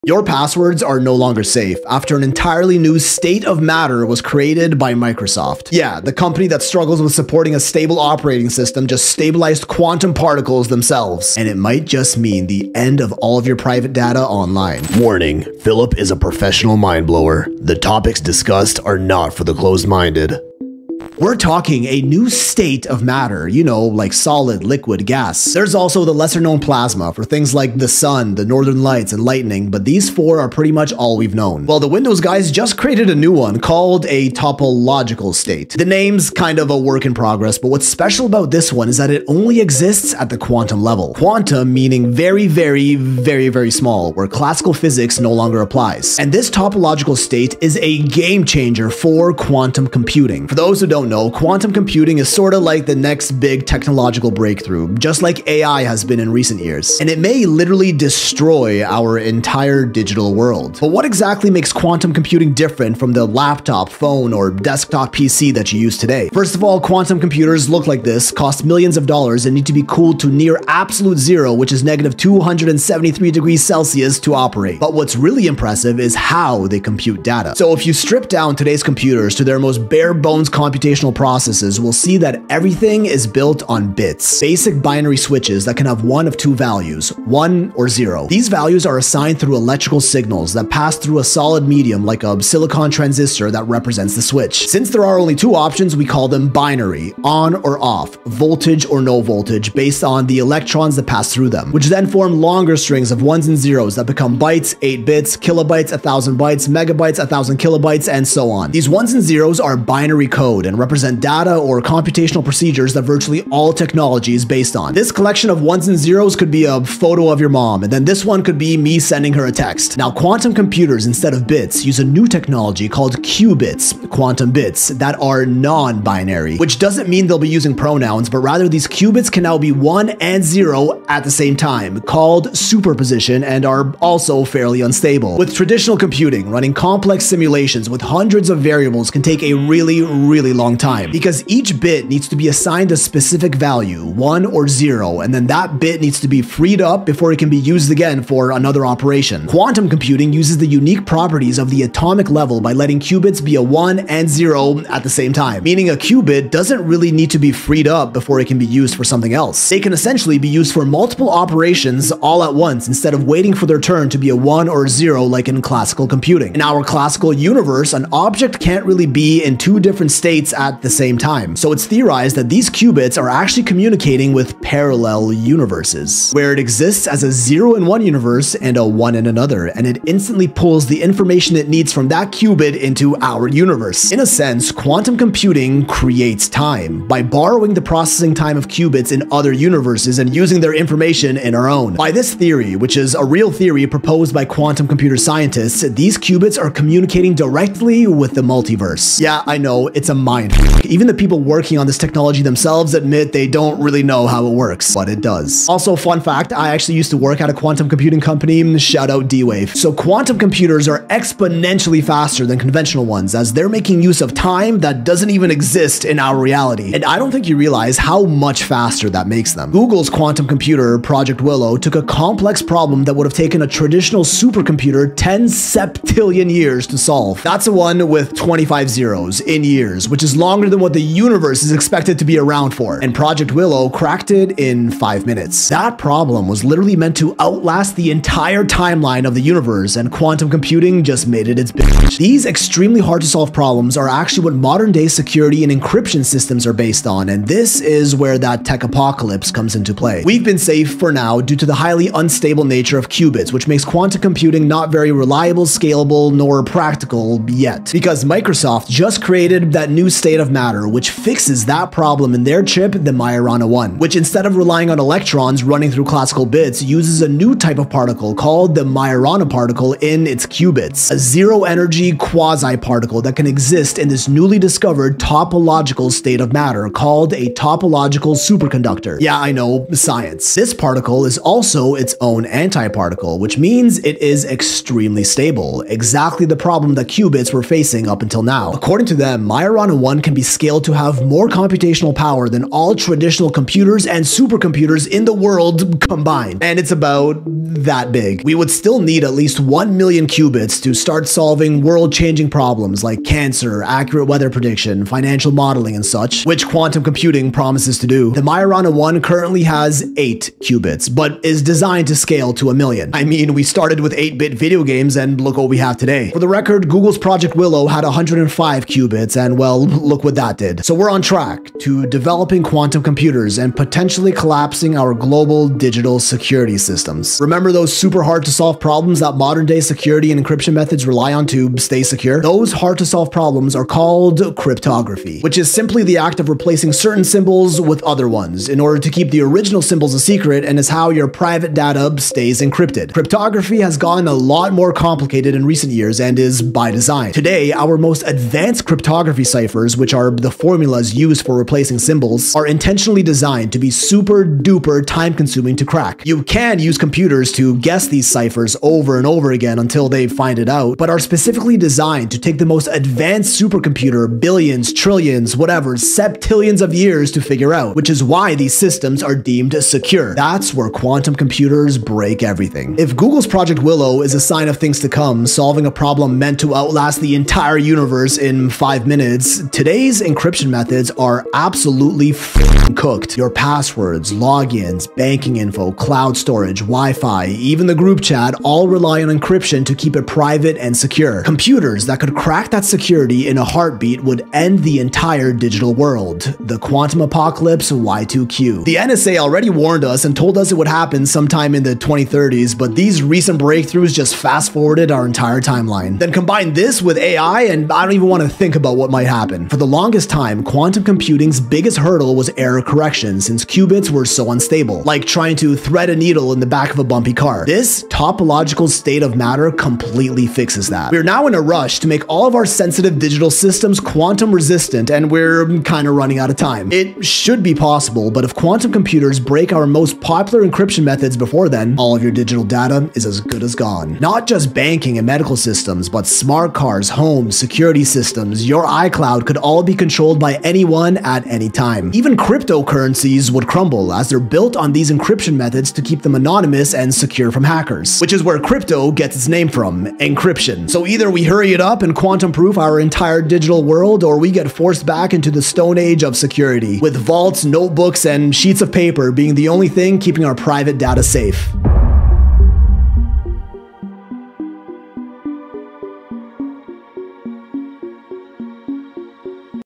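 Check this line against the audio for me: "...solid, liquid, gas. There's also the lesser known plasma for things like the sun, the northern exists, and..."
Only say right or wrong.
wrong.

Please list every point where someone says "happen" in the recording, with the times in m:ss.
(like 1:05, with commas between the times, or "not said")
6:40, 6:49.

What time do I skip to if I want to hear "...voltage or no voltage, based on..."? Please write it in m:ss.
1:38.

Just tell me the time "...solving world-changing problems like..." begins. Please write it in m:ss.
5:01.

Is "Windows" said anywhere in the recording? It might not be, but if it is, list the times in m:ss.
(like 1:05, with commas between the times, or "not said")
0:31.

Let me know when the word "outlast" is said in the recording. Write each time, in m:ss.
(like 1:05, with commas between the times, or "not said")
3:57, 6:16.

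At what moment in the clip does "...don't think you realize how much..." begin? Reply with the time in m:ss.
3:37.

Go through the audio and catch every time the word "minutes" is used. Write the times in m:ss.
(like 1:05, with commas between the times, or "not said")
3:55, 6:19.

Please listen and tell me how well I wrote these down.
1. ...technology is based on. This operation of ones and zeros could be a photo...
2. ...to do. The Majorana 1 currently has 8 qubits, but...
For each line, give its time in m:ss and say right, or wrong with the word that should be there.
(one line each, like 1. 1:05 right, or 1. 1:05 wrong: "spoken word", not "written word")
1. 1:53 wrong: "collection", not "operation"
2. 5:07 right.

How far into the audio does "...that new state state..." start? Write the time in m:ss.
4:19.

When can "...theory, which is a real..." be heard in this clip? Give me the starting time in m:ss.
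3:12.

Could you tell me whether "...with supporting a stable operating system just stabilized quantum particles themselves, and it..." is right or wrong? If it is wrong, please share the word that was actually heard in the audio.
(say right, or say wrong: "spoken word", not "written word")
right.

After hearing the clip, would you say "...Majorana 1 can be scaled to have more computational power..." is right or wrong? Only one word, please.
right.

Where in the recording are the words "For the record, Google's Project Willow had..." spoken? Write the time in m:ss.
5:16.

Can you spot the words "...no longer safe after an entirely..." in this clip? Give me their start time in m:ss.
0:00.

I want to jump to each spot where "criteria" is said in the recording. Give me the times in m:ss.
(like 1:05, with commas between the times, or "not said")
not said.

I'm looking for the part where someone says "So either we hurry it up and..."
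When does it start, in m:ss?
7:30.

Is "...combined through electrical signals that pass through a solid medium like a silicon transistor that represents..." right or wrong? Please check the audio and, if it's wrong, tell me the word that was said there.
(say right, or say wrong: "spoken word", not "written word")
wrong: "assigned", not "combined".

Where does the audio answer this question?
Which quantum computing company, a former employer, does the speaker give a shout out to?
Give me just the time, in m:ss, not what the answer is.
3:29.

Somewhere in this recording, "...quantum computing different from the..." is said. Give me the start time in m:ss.
1:01.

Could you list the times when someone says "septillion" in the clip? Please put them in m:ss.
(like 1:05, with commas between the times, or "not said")
3:45, 6:05.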